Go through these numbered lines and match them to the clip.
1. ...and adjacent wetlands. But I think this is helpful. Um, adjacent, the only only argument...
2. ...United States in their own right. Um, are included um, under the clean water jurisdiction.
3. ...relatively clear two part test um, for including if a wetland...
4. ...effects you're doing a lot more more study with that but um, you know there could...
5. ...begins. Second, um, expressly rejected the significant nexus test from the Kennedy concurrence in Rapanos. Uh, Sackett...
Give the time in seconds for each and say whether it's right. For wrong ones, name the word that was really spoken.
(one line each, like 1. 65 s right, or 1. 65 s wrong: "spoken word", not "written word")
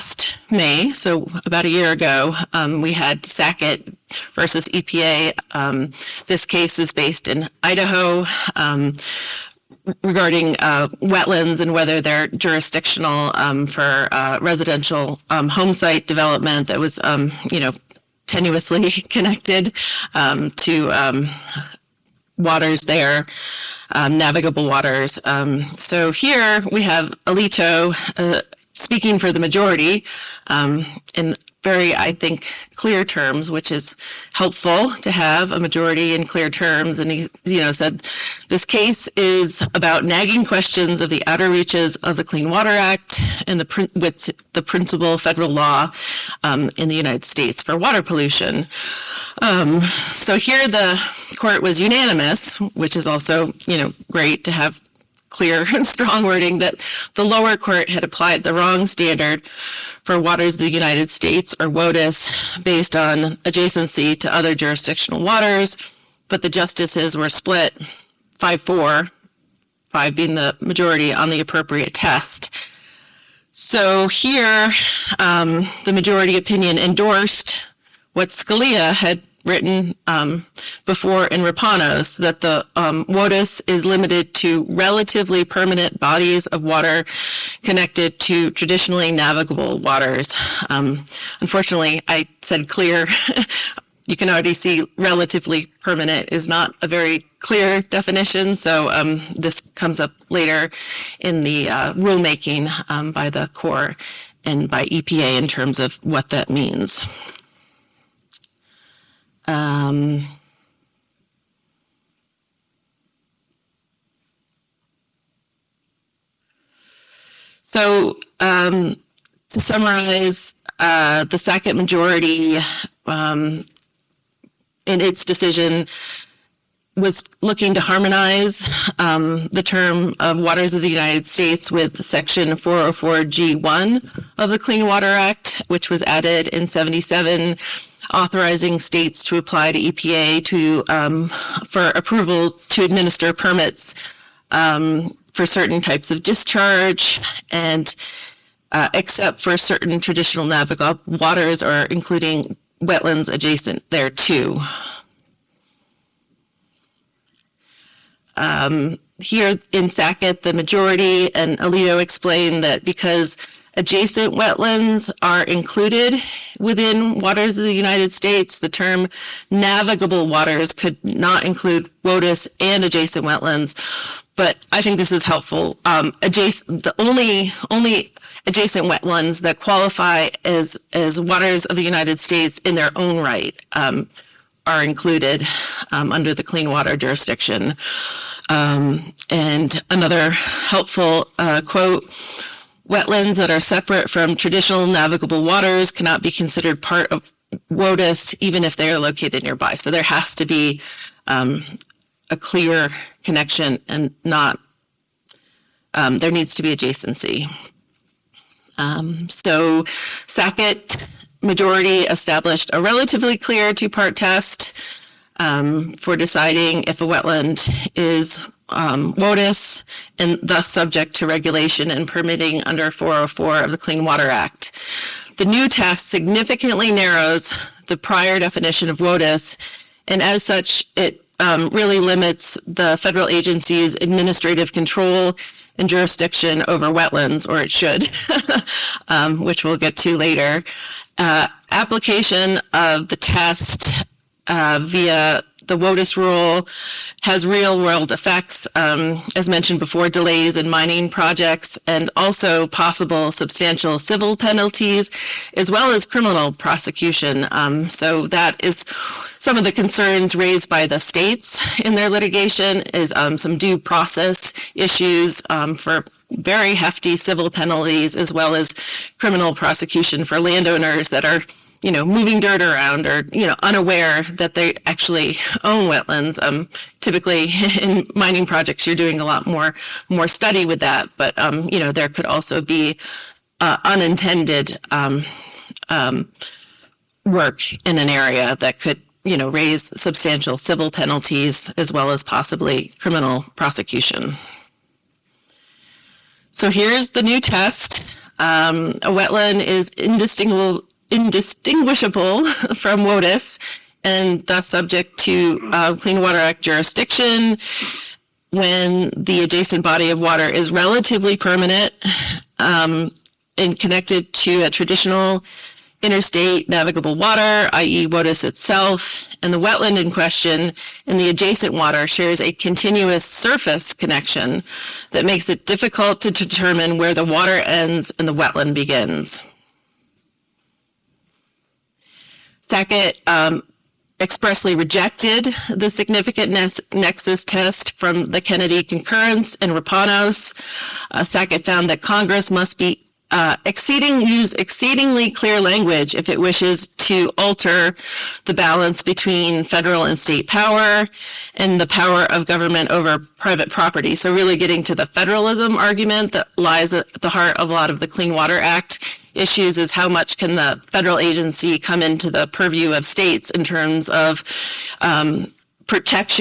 1. 172 s wrong: "adjacent", not "argument"
2. 181 s right
3. 212 s wrong: "deciding", not "including"
4. 278 s wrong: "projects", not "effects"
5. 328 s right.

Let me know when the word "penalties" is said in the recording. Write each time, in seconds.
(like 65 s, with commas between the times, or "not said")
254 s, 267 s, 290 s.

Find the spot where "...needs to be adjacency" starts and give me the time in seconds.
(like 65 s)
206 s.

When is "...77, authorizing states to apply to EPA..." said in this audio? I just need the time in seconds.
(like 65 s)
136 s.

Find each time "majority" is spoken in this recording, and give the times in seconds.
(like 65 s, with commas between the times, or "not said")
29 s, 35 s, 70 s, 75 s, 121 s, 160 s, 211 s.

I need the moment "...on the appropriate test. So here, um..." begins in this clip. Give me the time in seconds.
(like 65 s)
71 s.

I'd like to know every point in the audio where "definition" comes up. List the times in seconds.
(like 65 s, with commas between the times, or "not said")
97 s, 228 s.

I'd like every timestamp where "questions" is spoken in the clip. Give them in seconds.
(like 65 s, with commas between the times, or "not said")
40 s, 320 s.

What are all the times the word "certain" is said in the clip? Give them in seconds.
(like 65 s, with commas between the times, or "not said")
145 s, 149 s.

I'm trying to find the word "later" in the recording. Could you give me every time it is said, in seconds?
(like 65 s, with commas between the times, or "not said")
100 s, 240 s.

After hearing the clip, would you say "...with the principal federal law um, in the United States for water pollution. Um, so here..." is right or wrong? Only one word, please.
right.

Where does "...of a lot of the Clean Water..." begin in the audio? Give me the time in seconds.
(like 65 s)
357 s.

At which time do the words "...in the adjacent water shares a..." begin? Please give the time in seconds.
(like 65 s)
321 s.